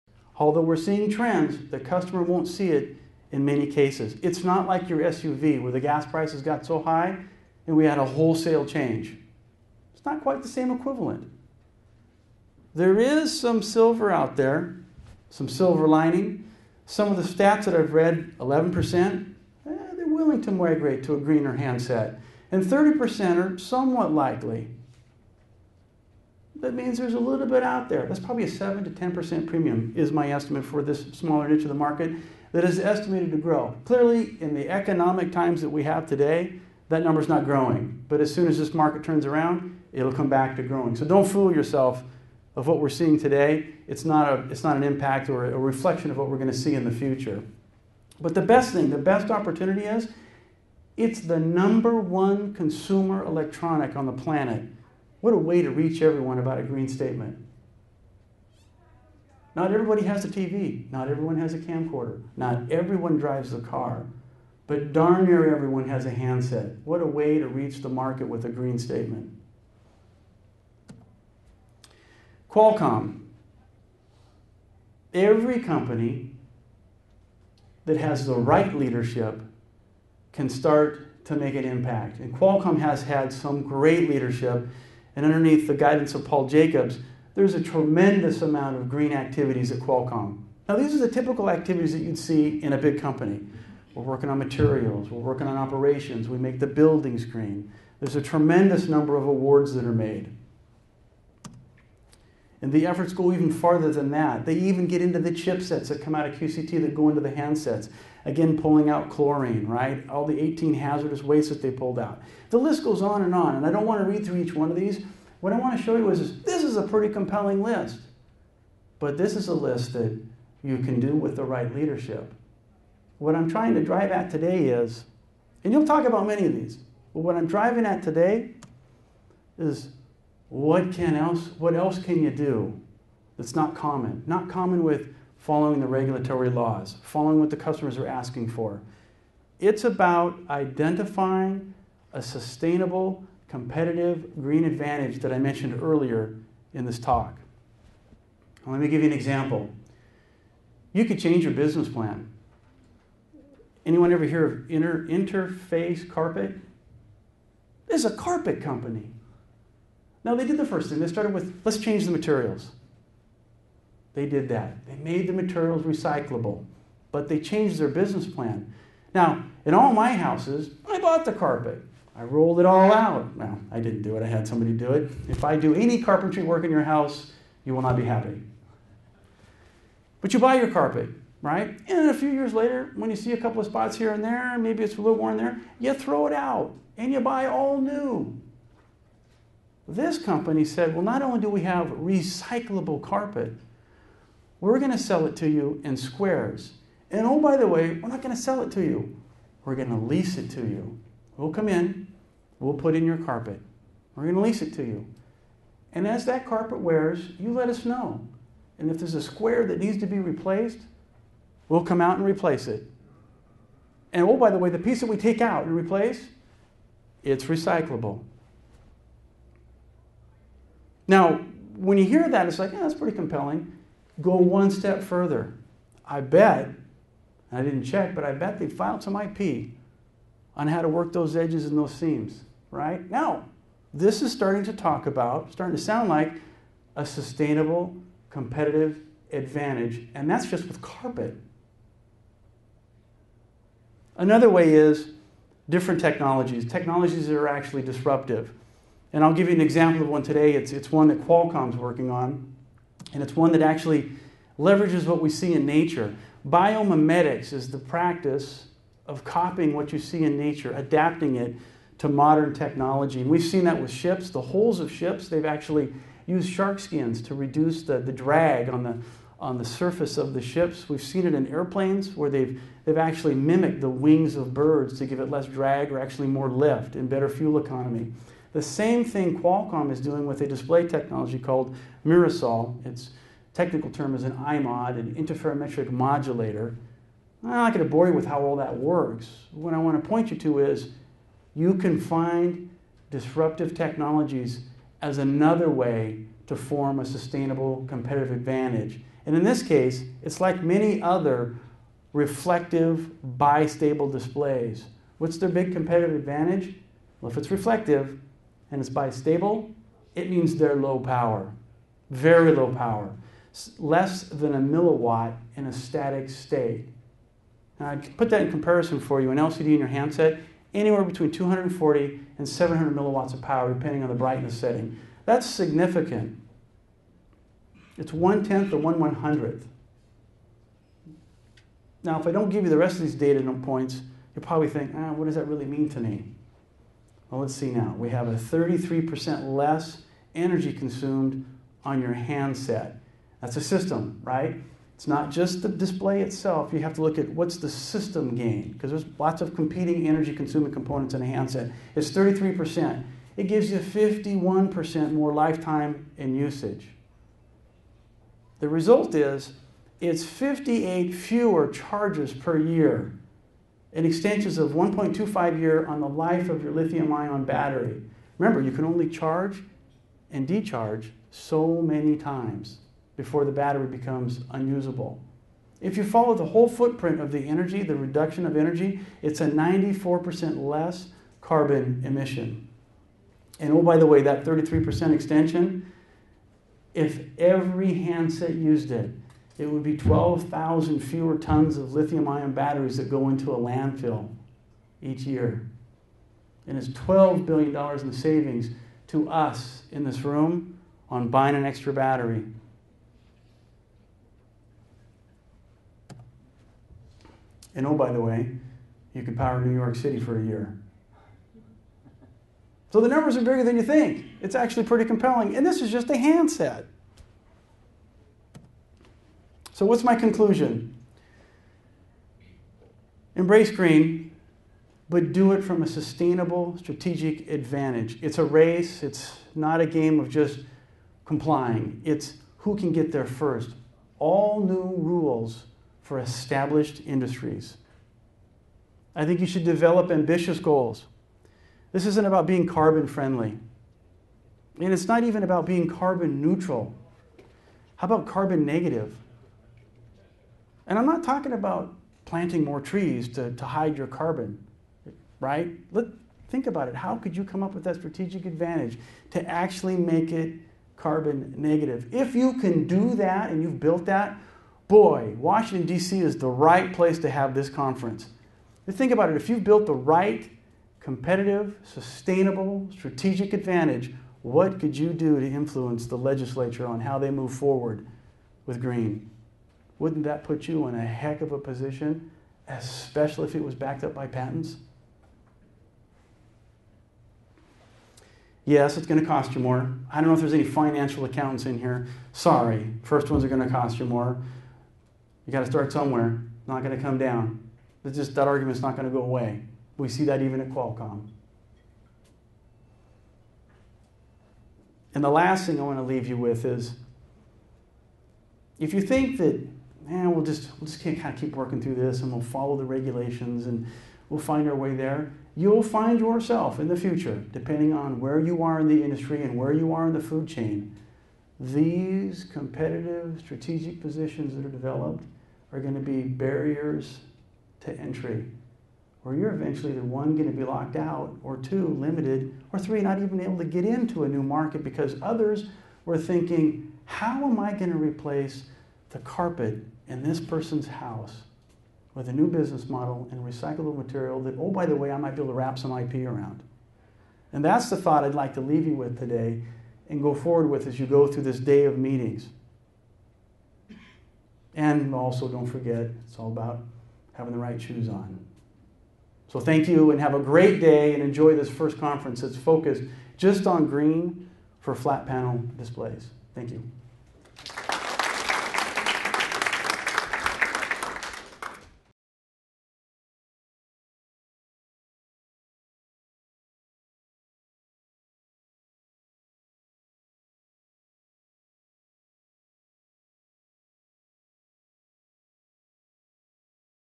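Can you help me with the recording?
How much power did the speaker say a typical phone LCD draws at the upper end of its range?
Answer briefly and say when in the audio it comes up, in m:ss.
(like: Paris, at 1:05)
700 milliwatts, at 5:22.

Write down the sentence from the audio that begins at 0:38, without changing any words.
But as soon as this market turns around, it'll come back to growing.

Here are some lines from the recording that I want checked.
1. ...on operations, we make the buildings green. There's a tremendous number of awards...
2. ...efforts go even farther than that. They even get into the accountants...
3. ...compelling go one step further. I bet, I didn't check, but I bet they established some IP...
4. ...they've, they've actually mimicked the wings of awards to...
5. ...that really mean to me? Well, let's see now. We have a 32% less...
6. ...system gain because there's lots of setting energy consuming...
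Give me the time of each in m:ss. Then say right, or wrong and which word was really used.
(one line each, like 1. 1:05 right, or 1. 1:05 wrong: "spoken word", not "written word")
1. 1:35 right
2. 1:42 wrong: "chipsets", not "accountants"
3. 3:43 wrong: "filed", not "established"
4. 4:32 wrong: "birds", not "awards"
5. 5:35 wrong: "33", not "32"
6. 5:47 wrong: "competing", not "setting".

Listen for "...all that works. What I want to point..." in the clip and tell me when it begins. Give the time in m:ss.
4:48.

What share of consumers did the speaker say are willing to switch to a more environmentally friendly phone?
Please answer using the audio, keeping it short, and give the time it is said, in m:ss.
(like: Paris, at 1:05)
11%, at 0:18.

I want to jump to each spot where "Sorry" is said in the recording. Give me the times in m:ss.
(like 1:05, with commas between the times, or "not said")
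8:12.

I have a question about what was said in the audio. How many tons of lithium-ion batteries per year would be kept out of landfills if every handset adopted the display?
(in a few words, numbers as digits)
12,000.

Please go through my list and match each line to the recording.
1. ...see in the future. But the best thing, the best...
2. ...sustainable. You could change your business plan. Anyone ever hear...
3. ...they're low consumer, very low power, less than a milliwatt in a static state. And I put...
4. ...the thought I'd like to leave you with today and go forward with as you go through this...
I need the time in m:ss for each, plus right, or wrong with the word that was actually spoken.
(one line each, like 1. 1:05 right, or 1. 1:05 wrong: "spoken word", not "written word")
1. 0:46 right
2. 2:29 wrong: "example", not "sustainable"
3. 5:10 wrong: "power", not "consumer"
4. 9:07 right.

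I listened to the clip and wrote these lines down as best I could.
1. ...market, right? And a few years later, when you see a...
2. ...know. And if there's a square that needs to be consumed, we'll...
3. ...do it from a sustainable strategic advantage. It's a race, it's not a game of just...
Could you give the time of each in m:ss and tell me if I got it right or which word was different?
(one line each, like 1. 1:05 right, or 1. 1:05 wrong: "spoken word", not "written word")
1. 3:00 wrong: "carpet", not "market"
2. 3:27 wrong: "replaced", not "consumed"
3. 7:05 right.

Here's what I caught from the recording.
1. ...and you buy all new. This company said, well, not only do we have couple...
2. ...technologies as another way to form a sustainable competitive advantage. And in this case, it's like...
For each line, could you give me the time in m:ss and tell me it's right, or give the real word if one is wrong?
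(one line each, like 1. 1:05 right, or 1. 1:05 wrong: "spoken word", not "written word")
1. 3:06 wrong: "recyclable", not "couple"
2. 4:53 right.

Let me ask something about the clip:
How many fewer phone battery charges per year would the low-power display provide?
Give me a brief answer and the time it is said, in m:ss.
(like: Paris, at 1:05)
58, at 6:00.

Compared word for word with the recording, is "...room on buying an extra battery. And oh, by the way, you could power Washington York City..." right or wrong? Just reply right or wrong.
wrong.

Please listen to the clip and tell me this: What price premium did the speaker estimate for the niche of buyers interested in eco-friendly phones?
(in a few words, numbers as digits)
7 to 10%.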